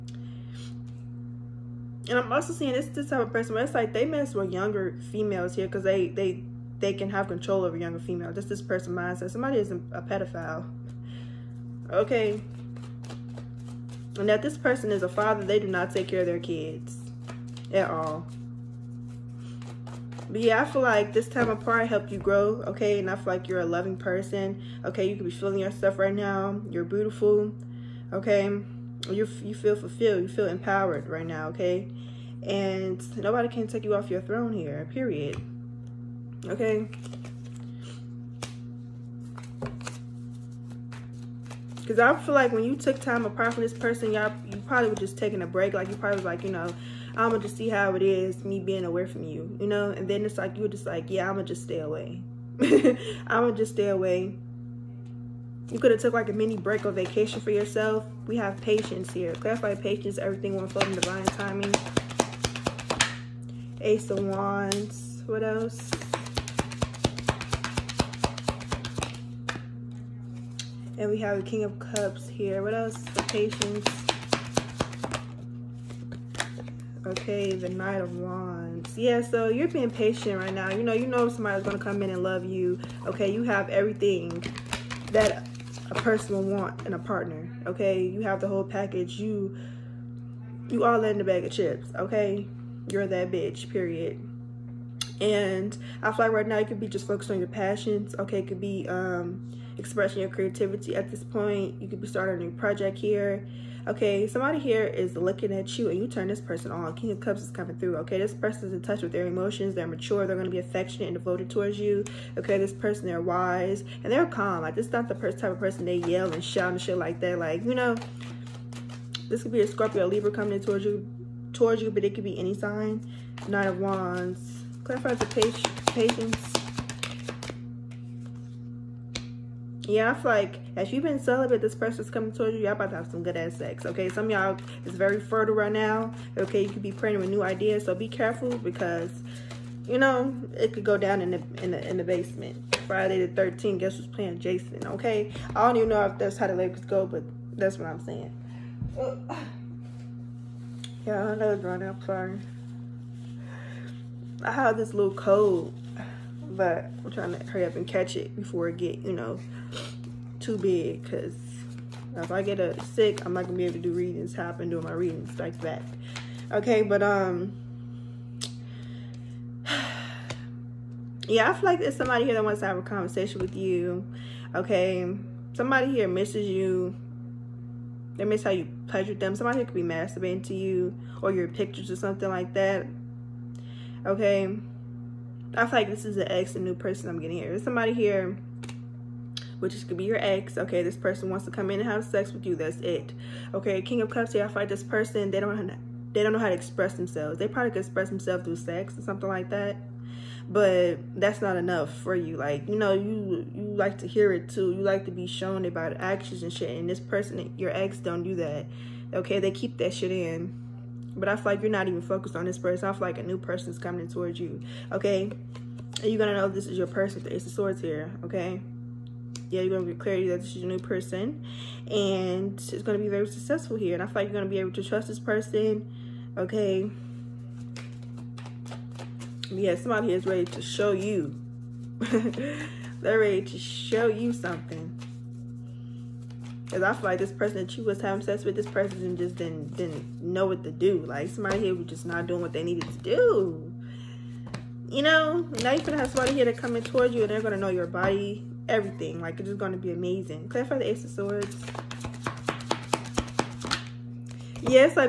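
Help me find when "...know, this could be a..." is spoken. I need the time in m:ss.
1:57.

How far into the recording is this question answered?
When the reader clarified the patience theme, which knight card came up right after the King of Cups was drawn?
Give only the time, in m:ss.
1:17.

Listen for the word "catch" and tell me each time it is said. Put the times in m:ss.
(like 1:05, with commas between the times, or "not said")
2:37.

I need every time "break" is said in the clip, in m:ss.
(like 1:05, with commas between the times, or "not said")
0:45, 0:56.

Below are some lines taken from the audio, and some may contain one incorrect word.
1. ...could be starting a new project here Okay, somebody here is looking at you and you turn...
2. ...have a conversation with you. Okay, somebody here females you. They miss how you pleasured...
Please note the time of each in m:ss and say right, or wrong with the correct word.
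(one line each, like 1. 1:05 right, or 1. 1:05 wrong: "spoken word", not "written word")
1. 1:41 right
2. 2:52 wrong: "misses", not "females".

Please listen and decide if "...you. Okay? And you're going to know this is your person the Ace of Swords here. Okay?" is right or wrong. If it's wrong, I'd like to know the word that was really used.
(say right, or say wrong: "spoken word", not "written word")
right.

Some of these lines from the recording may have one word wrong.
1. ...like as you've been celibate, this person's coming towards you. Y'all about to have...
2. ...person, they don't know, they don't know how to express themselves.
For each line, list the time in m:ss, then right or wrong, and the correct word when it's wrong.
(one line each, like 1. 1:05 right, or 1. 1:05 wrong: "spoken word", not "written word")
1. 2:10 right
2. 3:14 right.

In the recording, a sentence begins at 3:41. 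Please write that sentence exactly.
And it's going to be very successful here.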